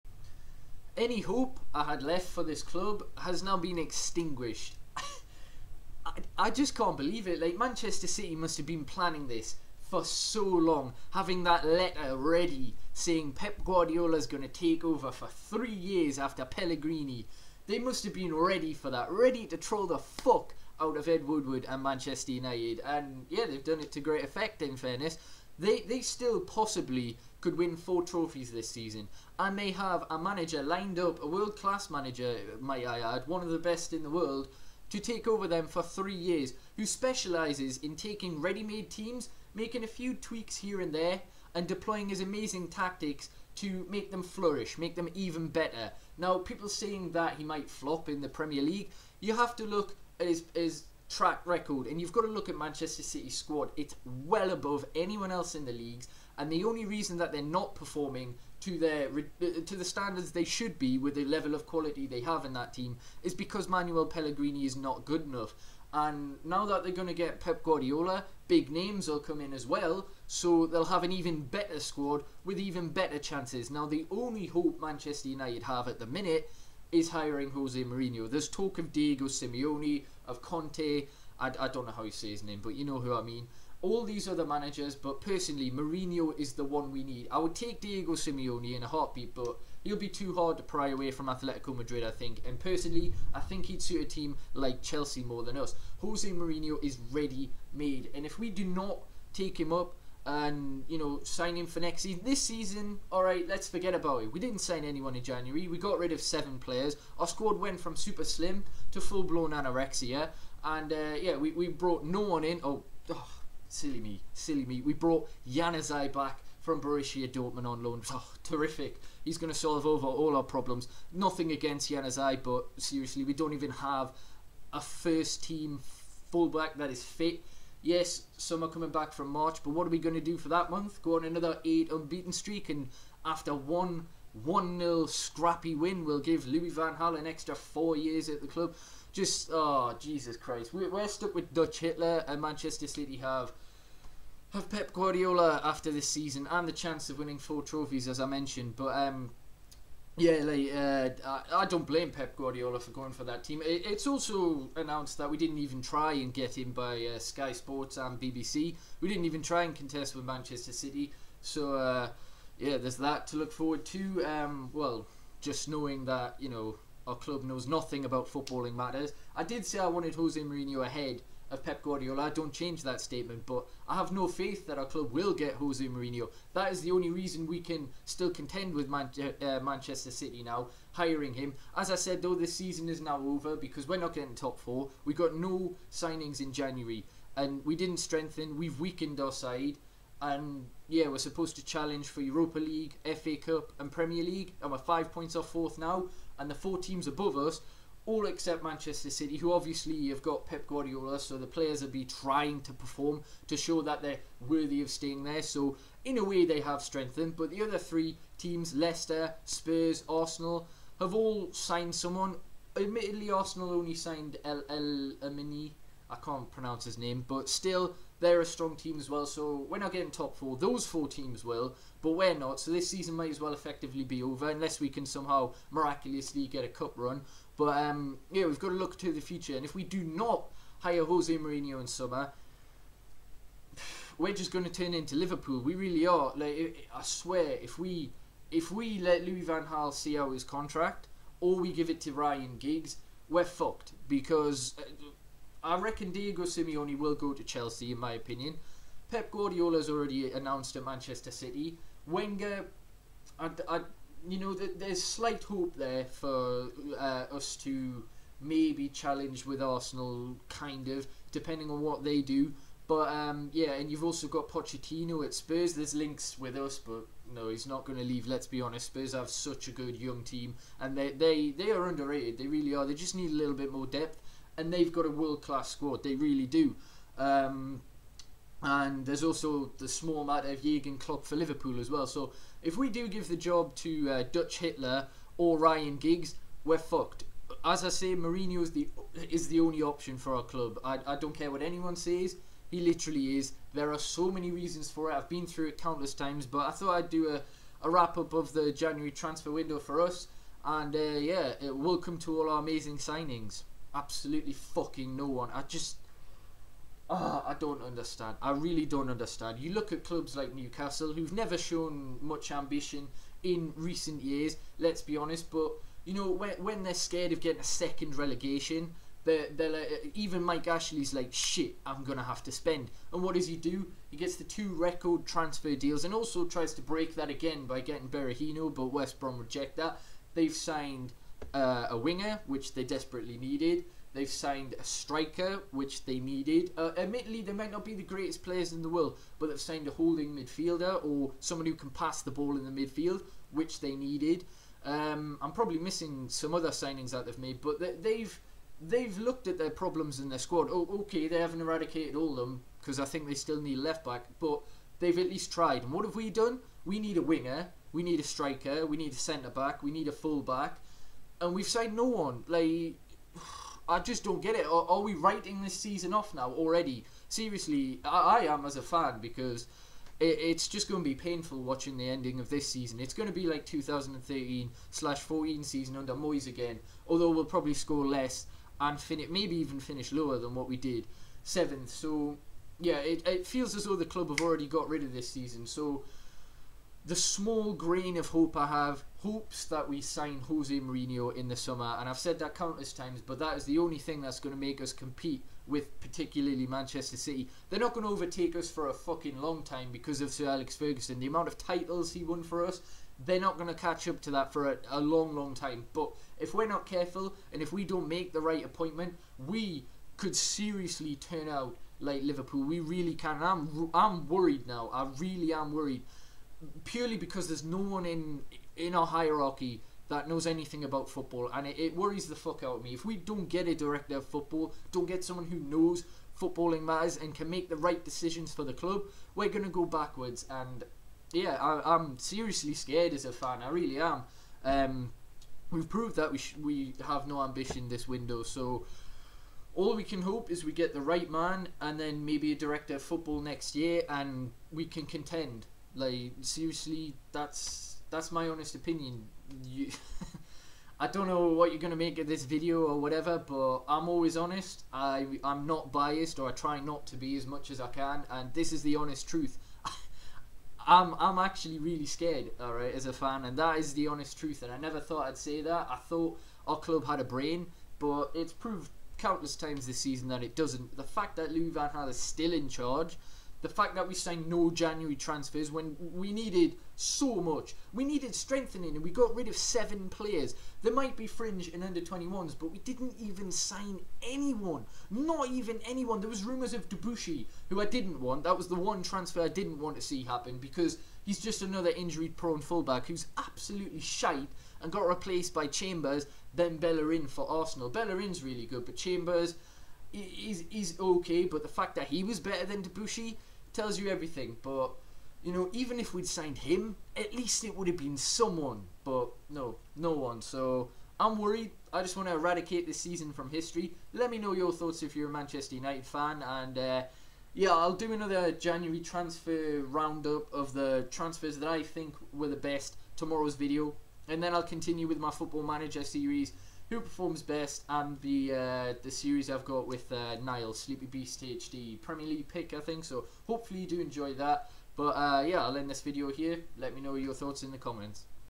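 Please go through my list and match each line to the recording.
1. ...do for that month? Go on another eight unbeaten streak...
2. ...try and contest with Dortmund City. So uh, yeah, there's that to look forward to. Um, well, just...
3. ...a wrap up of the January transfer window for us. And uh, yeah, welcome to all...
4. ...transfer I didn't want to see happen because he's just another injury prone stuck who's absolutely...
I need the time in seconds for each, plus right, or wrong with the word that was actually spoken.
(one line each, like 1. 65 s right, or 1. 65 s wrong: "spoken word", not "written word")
1. 130 s right
2. 159 s wrong: "Manchester", not "Dortmund"
3. 297 s right
4. 489 s wrong: "fullback", not "stuck".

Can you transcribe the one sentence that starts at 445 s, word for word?
Like seriously, that's that's my honest opinion.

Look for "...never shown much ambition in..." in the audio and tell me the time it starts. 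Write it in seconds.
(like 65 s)
311 s.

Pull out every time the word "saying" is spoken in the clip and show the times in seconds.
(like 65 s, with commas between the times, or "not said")
12 s, 46 s.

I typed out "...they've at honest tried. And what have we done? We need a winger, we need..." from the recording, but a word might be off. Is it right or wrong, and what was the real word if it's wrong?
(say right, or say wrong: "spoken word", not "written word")
wrong: "least", not "honest".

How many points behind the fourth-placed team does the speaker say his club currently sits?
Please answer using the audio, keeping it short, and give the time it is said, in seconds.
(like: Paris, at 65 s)
5, at 194 s.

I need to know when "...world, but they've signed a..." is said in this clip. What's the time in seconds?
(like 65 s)
338 s.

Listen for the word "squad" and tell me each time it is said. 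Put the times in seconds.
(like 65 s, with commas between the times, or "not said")
53 s, 71 s, 107 s, 275 s, 350 s.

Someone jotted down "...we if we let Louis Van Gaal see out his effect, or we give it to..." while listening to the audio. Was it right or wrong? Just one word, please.
wrong.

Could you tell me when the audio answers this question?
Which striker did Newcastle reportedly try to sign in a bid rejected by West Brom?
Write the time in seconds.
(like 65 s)
328 s.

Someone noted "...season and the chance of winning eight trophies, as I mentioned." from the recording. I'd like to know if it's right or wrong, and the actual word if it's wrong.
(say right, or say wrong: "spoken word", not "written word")
wrong: "four", not "eight".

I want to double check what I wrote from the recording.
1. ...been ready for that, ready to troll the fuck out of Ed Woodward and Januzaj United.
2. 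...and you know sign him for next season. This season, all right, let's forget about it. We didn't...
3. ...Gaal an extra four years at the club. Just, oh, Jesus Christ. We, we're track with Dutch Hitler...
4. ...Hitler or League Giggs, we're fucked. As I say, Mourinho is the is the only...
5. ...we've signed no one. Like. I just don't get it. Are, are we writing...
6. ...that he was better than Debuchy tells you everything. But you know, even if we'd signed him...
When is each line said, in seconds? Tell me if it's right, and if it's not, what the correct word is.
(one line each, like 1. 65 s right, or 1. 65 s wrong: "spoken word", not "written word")
1. 18 s wrong: "Manchester", not "Januzaj"
2. 100 s right
3. 136 s wrong: "stuck", not "track"
4. 284 s wrong: "Ryan", not "League"
5. 361 s right
6. 501 s right.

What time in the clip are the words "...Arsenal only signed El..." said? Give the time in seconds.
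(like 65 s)
213 s.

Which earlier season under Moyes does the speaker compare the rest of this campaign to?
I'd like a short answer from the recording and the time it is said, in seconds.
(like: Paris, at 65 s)
2013/14, at 373 s.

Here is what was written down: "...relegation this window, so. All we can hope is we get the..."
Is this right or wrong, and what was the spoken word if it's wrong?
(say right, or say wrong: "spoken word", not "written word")
wrong: "ambition", not "relegation".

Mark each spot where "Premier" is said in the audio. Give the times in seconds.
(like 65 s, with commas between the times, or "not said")
48 s, 193 s, 532 s.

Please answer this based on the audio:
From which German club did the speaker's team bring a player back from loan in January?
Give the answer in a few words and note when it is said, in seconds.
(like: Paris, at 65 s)
Borussia Dortmund, at 116 s.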